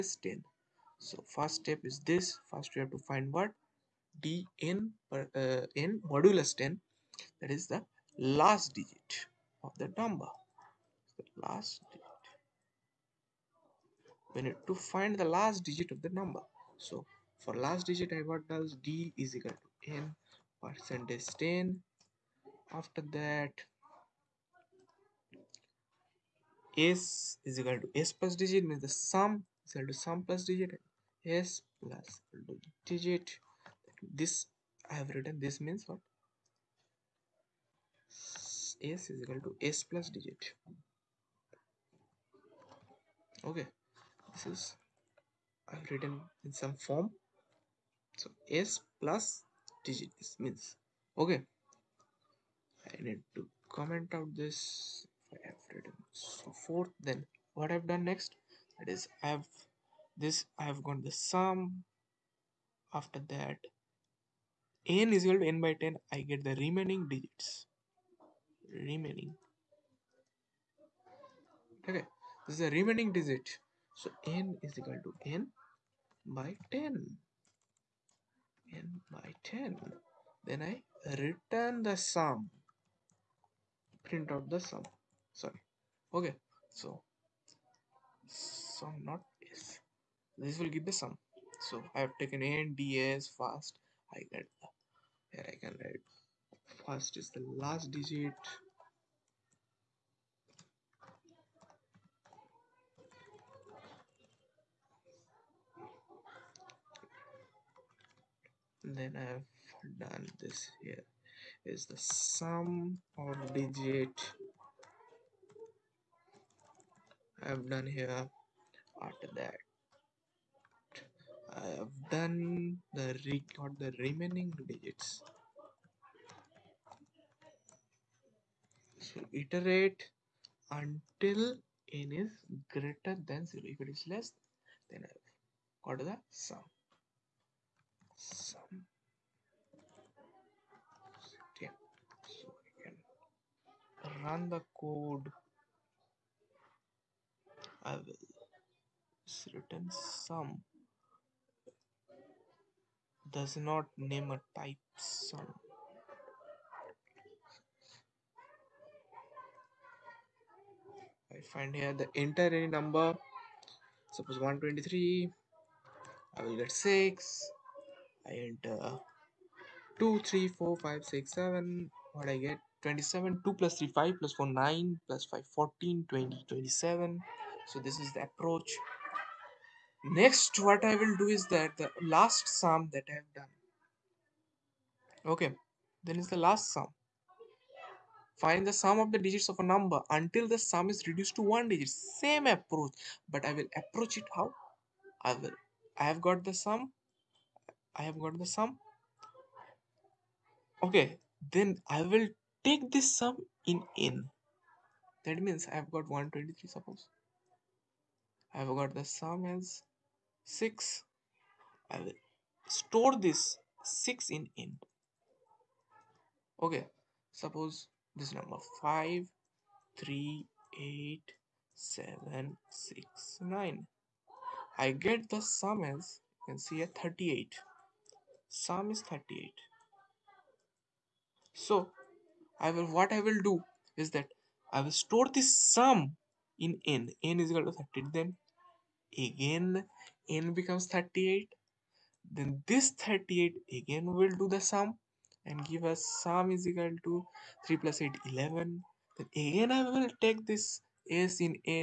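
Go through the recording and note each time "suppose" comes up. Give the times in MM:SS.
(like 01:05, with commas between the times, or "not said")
02:44, 03:26, 03:37.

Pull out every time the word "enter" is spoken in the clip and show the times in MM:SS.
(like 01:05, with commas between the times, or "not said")
02:42, 02:48.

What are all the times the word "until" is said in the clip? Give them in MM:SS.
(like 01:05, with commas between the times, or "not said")
02:10, 03:10.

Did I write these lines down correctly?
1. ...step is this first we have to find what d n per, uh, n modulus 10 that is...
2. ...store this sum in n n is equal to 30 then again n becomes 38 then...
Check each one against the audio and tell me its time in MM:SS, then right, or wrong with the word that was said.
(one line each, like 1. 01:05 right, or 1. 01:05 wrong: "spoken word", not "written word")
1. 00:01 right
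2. 03:55 right.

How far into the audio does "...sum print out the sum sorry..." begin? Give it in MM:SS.
01:22.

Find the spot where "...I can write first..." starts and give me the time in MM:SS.
01:35.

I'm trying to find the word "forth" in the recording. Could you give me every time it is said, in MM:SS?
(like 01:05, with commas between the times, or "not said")
00:56.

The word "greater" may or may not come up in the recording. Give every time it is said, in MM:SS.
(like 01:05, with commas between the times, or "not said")
02:12.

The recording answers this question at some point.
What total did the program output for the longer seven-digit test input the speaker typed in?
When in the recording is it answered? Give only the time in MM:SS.
02:52.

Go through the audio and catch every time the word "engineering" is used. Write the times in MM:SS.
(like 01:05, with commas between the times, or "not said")
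not said.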